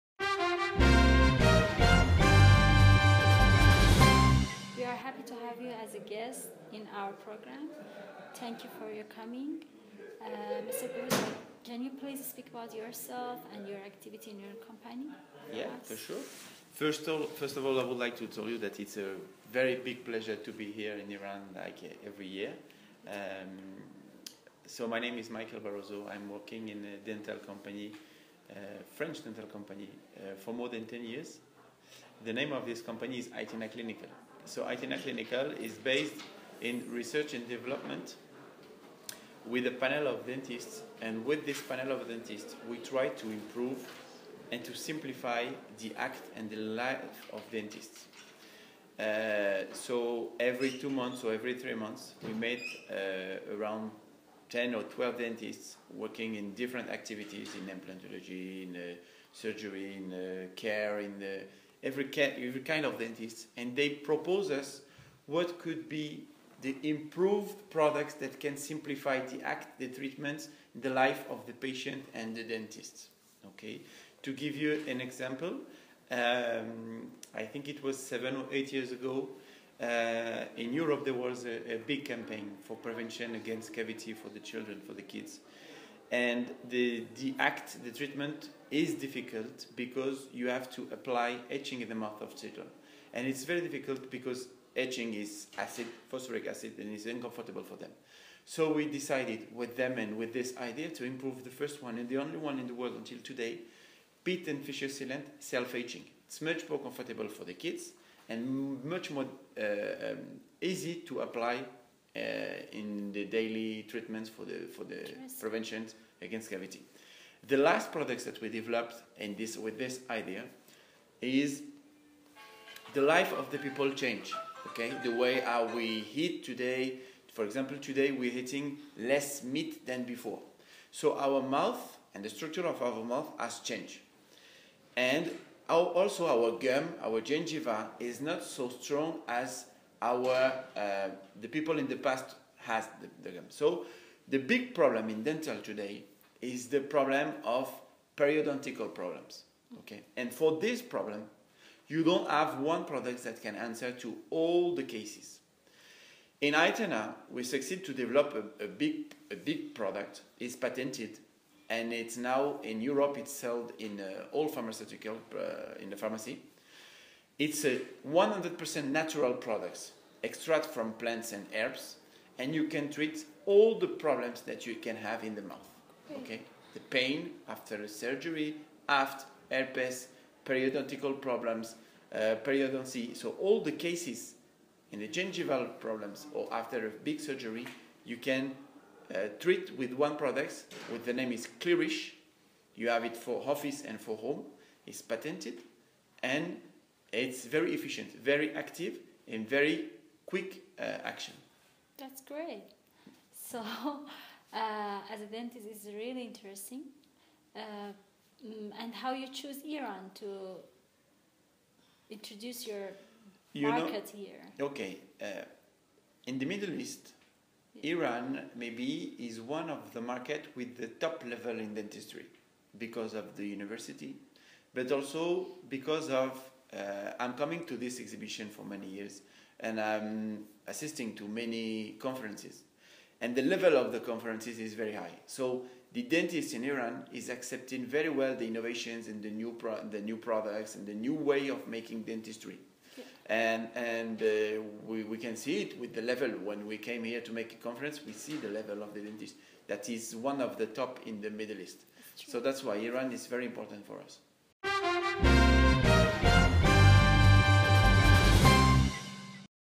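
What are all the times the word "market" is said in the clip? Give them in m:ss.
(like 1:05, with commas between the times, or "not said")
3:33, 3:40.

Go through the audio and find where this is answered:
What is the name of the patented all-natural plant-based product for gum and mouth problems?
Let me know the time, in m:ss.
3:11.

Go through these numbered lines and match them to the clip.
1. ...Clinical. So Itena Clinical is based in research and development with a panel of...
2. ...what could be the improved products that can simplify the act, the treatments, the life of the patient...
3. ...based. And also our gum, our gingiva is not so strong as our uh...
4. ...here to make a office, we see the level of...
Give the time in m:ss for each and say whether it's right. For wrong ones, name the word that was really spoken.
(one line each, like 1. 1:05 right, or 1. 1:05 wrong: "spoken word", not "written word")
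1. 0:33 right
2. 1:05 right
3. 2:13 wrong: "changed", not "based"
4. 4:07 wrong: "conference", not "office".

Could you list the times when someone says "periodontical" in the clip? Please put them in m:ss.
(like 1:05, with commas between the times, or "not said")
2:28, 3:00.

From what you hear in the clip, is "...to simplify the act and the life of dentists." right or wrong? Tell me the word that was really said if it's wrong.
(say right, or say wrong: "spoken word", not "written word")
right.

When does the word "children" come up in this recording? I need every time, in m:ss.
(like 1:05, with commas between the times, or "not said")
1:24, 1:32.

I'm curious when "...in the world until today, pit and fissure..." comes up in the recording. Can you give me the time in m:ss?
1:42.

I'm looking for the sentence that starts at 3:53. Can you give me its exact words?
And the level of the conferences is very high.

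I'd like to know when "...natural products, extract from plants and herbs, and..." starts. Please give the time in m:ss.
2:48.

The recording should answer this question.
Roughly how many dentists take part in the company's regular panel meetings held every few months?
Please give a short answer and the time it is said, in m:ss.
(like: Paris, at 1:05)
10 or 12, at 0:54.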